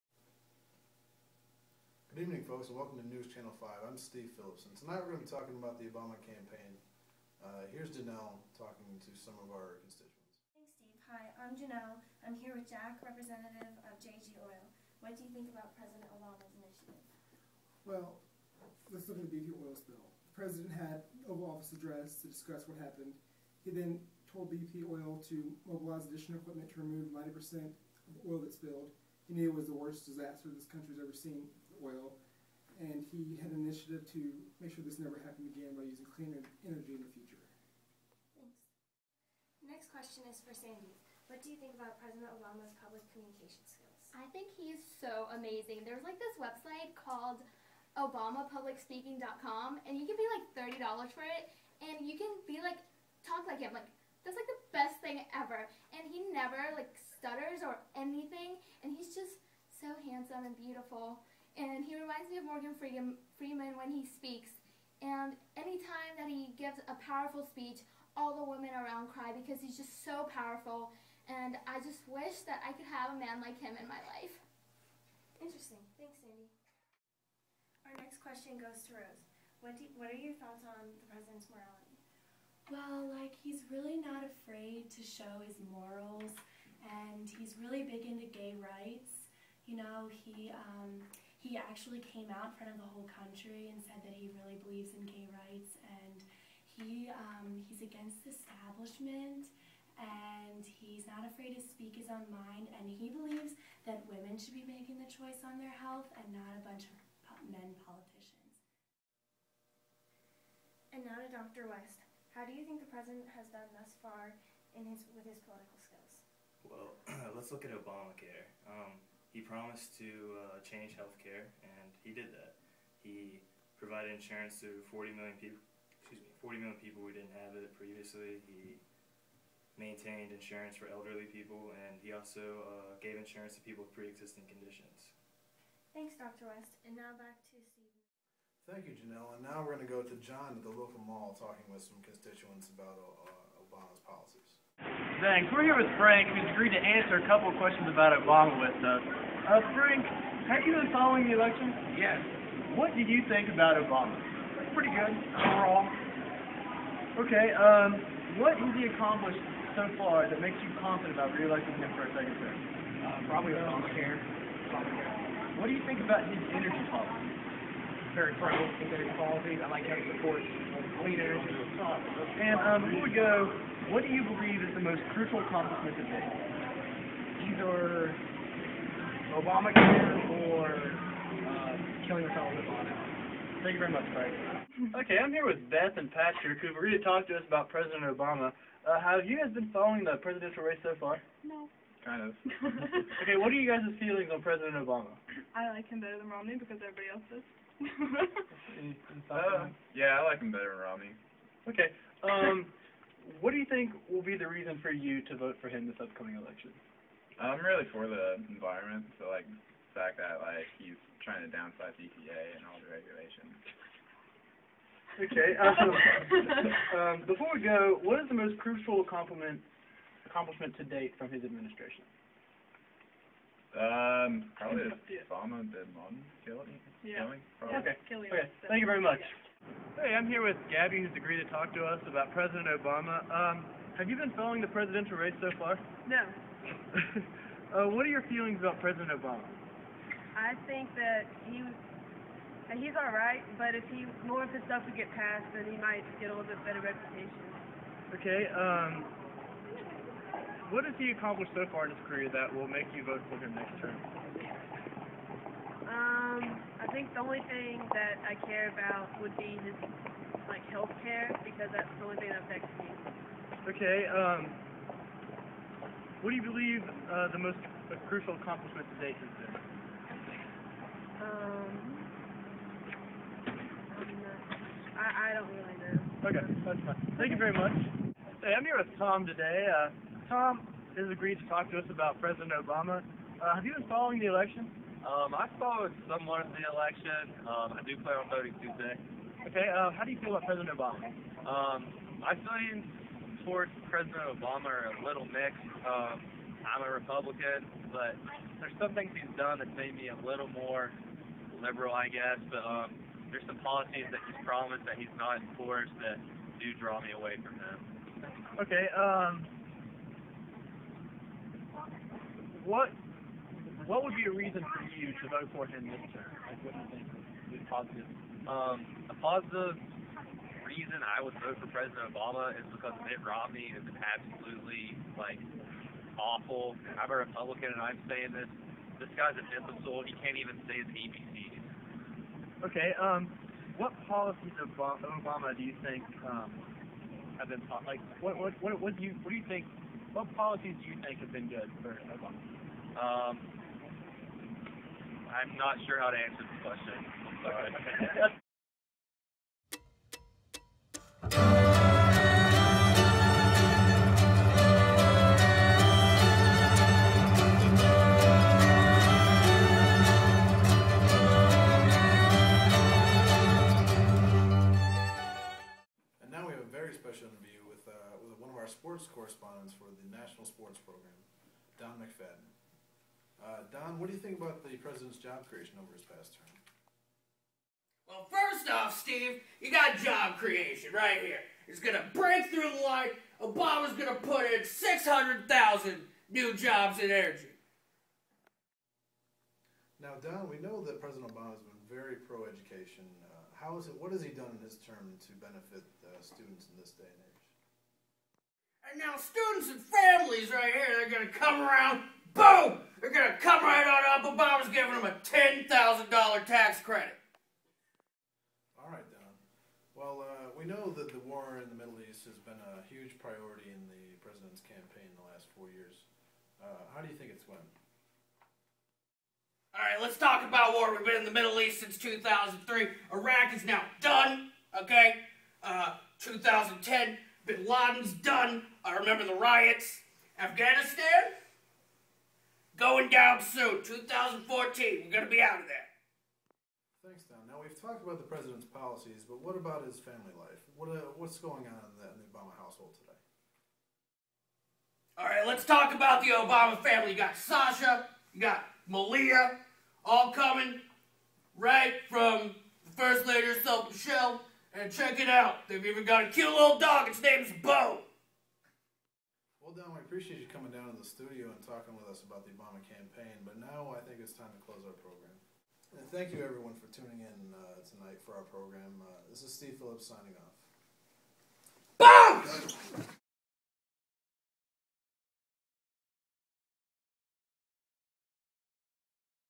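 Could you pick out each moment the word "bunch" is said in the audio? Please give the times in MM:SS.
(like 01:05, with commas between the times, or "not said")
01:46.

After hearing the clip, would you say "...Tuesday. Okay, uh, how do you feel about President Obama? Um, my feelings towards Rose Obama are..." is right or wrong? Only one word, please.
wrong.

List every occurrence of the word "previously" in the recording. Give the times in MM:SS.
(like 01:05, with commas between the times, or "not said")
02:07.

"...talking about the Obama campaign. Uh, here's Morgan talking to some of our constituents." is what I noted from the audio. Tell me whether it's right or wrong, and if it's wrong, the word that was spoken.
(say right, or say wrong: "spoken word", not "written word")
wrong: "Janelle", not "Morgan".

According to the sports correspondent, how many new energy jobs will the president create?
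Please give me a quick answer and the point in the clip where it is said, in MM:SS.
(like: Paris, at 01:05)
600,000, at 06:24.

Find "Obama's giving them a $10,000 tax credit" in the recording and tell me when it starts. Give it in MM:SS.
06:44.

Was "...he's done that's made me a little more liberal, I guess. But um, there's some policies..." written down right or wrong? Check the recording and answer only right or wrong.
right.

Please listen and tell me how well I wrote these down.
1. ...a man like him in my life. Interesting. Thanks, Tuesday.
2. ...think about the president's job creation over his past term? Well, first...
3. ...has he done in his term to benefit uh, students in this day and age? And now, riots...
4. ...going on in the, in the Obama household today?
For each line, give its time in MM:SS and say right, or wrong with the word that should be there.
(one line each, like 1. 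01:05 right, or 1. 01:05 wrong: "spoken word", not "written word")
1. 01:13 wrong: "Sandy", not "Tuesday"
2. 06:14 right
3. 06:34 wrong: "students", not "riots"
4. 07:21 right.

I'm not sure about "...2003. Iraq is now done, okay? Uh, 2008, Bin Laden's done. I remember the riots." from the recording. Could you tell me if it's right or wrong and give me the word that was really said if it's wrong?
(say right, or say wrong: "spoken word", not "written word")
wrong: "2010", not "2008".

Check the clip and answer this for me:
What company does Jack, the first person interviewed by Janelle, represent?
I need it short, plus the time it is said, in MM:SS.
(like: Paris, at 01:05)
JG Oil, at 00:13.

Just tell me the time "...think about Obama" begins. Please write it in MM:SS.
02:33.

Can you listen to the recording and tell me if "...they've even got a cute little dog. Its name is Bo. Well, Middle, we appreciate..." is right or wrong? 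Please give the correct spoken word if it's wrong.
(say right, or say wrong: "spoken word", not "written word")
wrong: "Don", not "Middle".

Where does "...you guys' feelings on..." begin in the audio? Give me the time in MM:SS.
03:13.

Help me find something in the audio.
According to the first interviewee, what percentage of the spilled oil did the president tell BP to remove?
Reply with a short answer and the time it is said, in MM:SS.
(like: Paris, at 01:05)
90%, at 00:27.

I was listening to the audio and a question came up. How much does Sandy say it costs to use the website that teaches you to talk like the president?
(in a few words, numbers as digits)
$30.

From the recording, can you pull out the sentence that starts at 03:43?
Um, probably Obama and Bin Laden killing?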